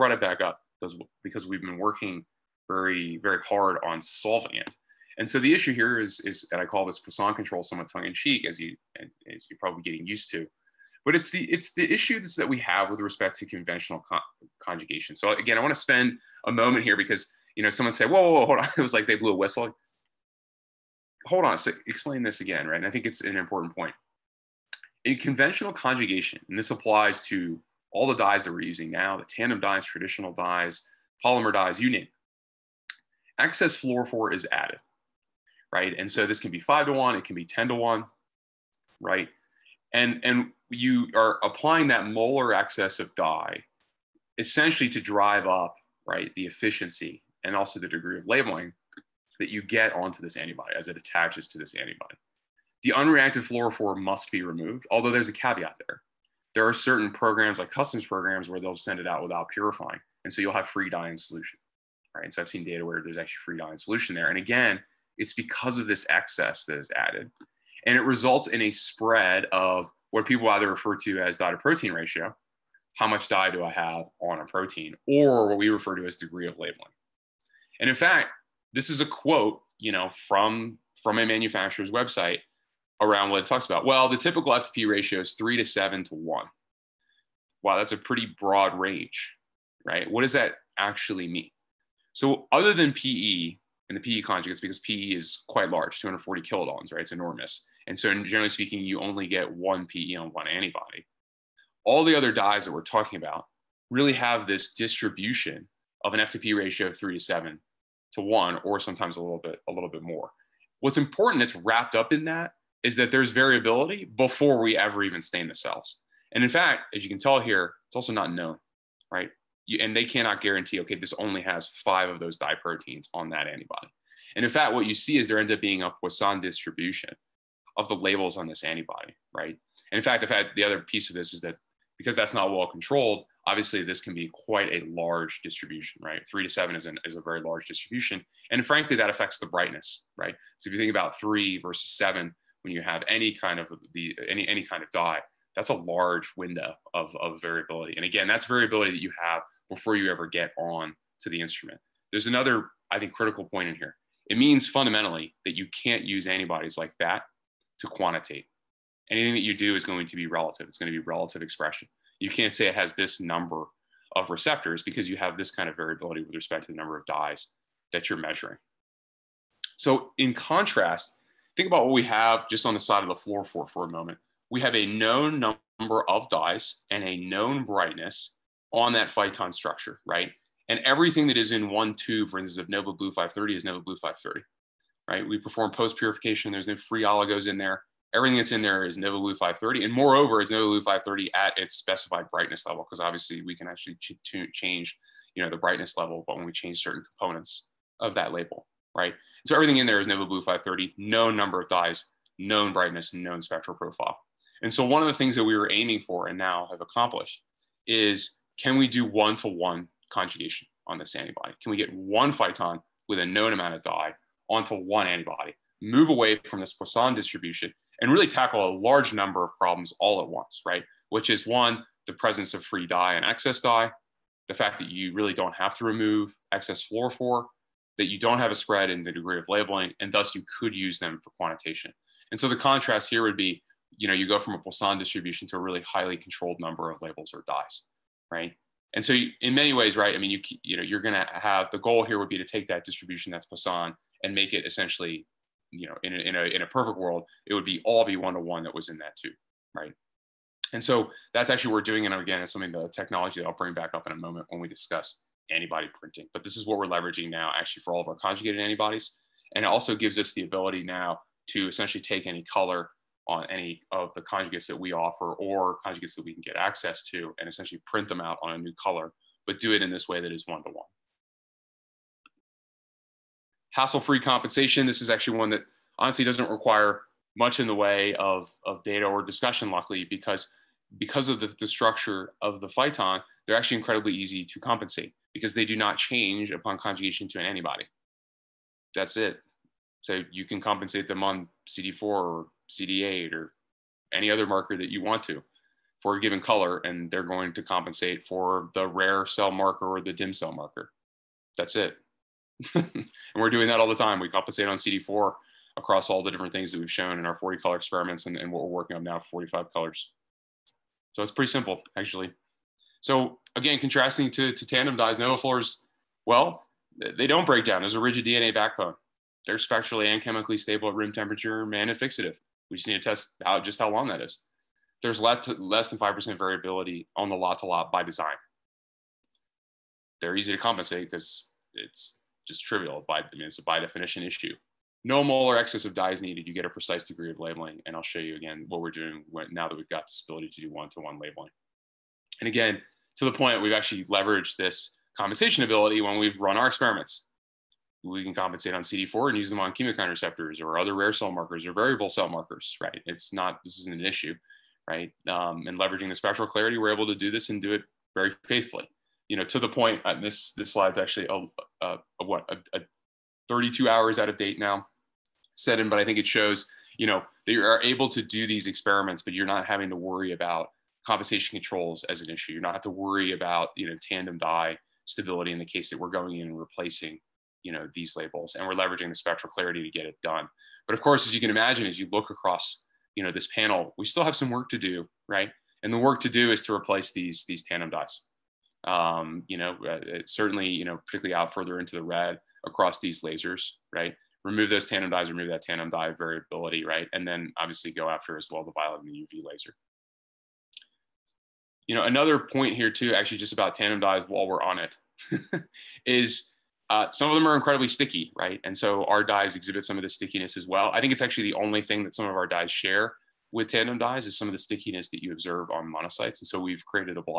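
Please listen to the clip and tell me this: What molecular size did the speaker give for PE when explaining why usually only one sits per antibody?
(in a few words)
240 kilodaltons.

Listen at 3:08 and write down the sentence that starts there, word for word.
Everything that's in there is Nova Blue 530.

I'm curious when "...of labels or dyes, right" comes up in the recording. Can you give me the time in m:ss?
3:56.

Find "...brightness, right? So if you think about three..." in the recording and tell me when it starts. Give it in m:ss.
2:19.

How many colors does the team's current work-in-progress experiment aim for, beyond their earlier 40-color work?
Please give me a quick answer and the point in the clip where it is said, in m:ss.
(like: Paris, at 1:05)
45, at 5:09.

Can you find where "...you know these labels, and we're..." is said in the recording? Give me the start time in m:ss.
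6:17.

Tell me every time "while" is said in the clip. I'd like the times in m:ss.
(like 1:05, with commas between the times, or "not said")
6:44.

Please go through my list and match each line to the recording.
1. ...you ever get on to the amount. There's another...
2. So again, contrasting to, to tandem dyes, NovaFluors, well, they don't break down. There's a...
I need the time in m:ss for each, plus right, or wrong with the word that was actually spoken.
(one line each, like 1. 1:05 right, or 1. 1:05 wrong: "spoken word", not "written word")
1. 2:29 wrong: "instrument", not "amount"
2. 5:13 right.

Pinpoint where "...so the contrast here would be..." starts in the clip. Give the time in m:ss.
3:52.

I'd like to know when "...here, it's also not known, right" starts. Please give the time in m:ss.
1:57.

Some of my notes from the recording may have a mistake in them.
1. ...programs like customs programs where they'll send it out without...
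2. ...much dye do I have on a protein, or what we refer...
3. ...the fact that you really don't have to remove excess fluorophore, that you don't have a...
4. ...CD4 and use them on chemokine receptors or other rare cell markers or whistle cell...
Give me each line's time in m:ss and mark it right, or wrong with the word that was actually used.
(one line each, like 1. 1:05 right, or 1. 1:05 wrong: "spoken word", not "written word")
1. 0:57 right
2. 1:13 right
3. 3:44 right
4. 5:48 wrong: "variable", not "whistle".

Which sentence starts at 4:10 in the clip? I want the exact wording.
And so that's actually what we're doing.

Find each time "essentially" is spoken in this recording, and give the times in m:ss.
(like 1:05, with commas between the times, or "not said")
0:44, 4:04, 4:21, 4:27.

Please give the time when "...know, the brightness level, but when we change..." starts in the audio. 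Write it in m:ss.
3:15.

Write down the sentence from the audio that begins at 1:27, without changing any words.
Wow, that's a pretty broad range, right?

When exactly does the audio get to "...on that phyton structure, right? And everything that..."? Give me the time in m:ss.
2:58.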